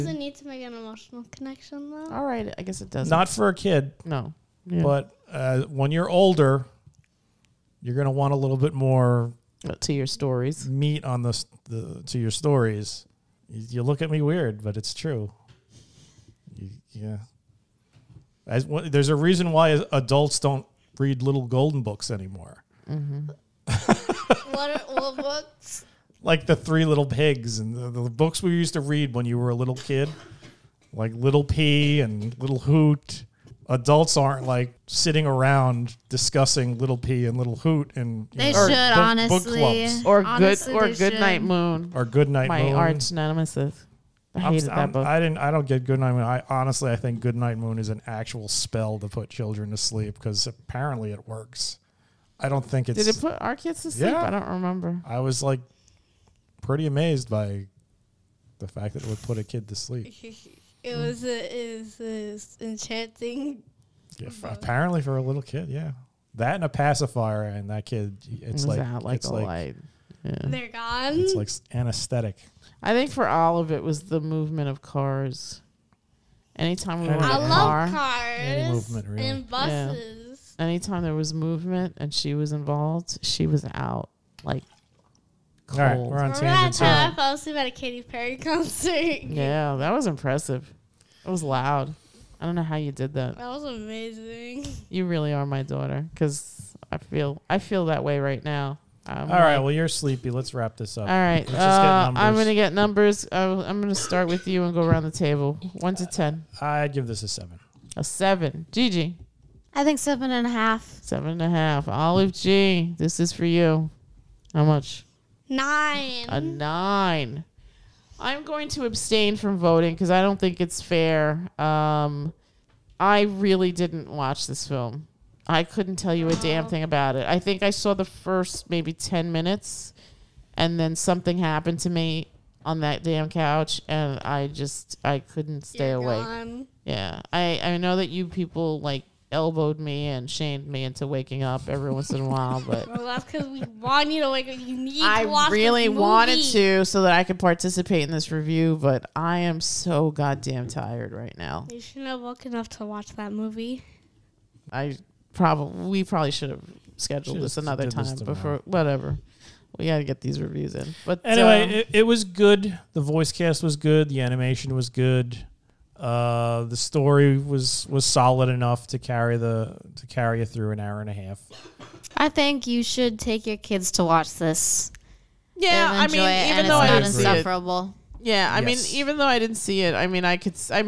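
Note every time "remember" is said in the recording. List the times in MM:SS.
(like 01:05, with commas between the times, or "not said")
00:54, 01:26.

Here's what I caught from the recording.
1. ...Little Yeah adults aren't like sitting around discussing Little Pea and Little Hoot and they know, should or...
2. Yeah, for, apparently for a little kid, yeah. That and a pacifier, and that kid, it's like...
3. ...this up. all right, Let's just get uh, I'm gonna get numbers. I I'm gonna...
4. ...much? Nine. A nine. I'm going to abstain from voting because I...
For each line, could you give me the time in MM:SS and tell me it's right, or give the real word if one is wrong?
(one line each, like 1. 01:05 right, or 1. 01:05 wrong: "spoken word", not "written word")
1. 00:32 wrong: "Hoot", not "Yeah"
2. 01:04 right
3. 01:40 right
4. 01:54 right.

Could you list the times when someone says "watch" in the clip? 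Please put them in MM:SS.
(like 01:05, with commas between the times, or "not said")
02:04, 02:32, 02:54.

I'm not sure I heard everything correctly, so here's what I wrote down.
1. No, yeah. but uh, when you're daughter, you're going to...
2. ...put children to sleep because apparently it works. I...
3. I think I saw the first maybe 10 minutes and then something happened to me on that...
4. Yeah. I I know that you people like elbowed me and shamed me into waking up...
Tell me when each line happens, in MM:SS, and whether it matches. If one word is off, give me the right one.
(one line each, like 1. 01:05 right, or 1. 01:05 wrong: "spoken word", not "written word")
1. 00:04 wrong: "older", not "daughter"
2. 00:49 right
3. 02:07 right
4. 02:16 right.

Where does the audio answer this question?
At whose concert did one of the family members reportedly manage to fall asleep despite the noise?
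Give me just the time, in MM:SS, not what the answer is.
01:27.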